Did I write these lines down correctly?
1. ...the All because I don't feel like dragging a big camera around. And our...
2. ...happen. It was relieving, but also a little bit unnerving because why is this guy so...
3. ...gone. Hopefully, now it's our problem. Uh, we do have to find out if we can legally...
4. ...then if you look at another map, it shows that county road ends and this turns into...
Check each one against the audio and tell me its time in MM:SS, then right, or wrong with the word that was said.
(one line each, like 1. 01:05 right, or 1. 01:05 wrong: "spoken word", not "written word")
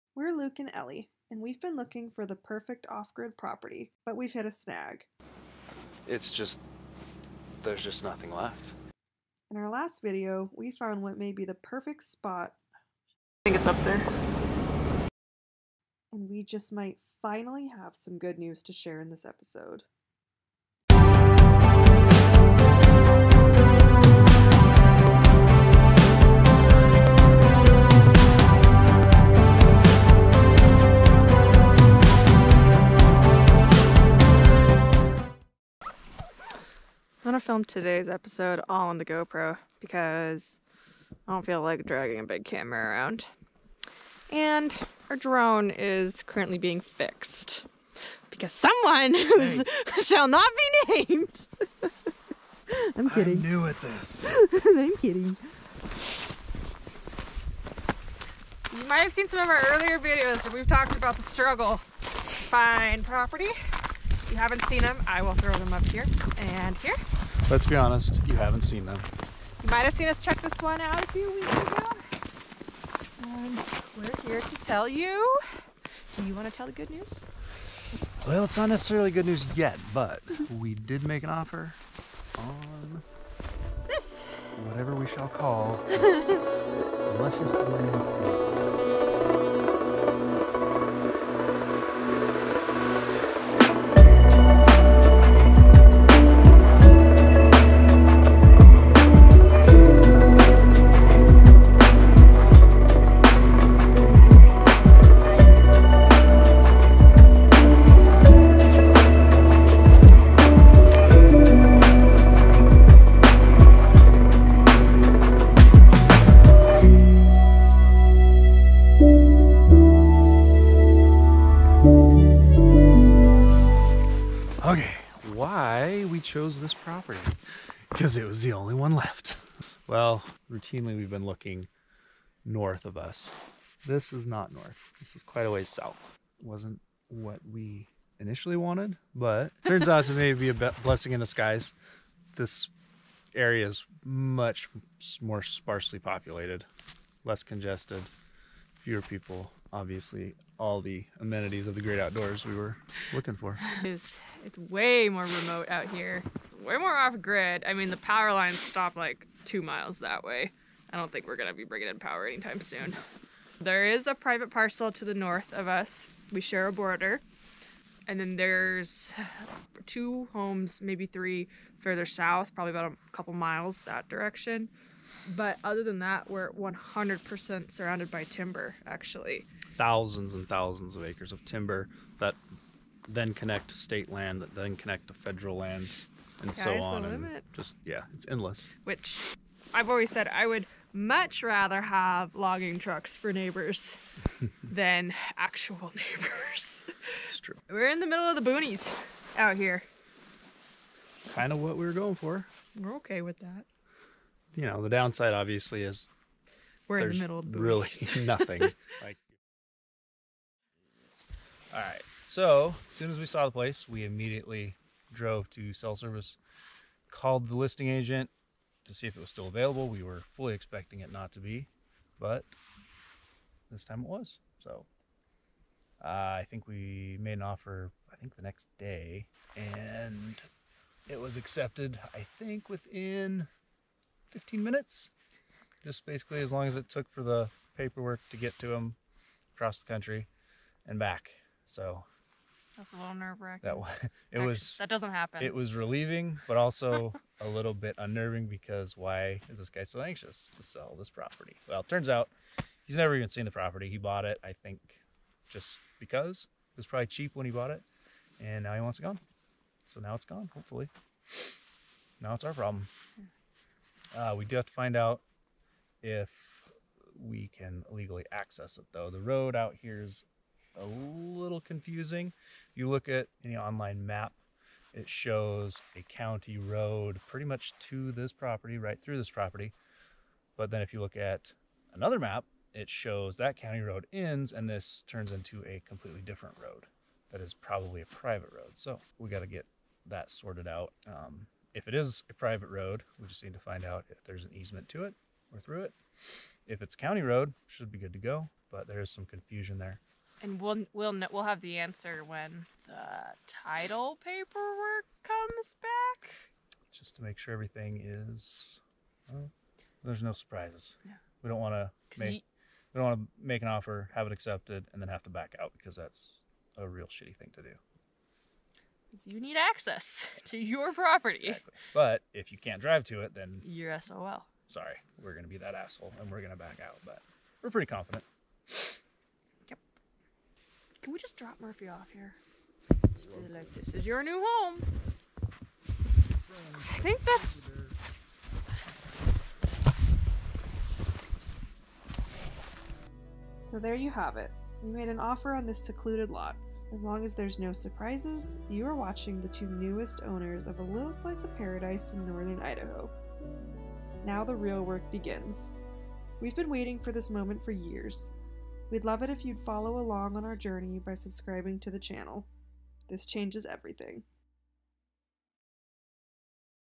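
1. 00:38 wrong: "GoPro", not "All"
2. 04:05 right
3. 04:20 right
4. 04:40 right.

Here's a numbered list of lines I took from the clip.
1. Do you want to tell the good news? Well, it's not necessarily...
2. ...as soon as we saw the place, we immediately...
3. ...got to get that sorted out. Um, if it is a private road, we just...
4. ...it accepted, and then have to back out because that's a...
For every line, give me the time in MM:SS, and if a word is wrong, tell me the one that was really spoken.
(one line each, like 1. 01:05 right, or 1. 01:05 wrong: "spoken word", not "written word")
1. 01:16 right
2. 03:32 right
3. 04:49 right
4. 05:14 right.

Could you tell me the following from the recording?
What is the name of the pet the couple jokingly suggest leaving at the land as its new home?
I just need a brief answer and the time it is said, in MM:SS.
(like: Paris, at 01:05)
Murphy, at 05:31.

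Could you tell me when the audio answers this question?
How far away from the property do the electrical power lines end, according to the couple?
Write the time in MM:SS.
02:39.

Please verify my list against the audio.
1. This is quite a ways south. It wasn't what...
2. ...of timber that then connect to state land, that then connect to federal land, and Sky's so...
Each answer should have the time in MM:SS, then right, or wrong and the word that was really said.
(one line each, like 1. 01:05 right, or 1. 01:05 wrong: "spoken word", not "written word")
1. 02:14 right
2. 03:01 right.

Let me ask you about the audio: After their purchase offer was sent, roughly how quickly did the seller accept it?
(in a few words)
15 minutes.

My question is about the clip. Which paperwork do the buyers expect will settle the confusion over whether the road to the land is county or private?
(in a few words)
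title paperwork.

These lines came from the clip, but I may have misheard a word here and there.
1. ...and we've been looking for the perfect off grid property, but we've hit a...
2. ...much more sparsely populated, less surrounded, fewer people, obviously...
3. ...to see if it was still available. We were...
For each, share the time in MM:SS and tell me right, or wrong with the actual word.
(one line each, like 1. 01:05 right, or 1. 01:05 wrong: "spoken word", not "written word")
1. 00:01 right
2. 02:24 wrong: "congested", not "surrounded"
3. 03:38 right.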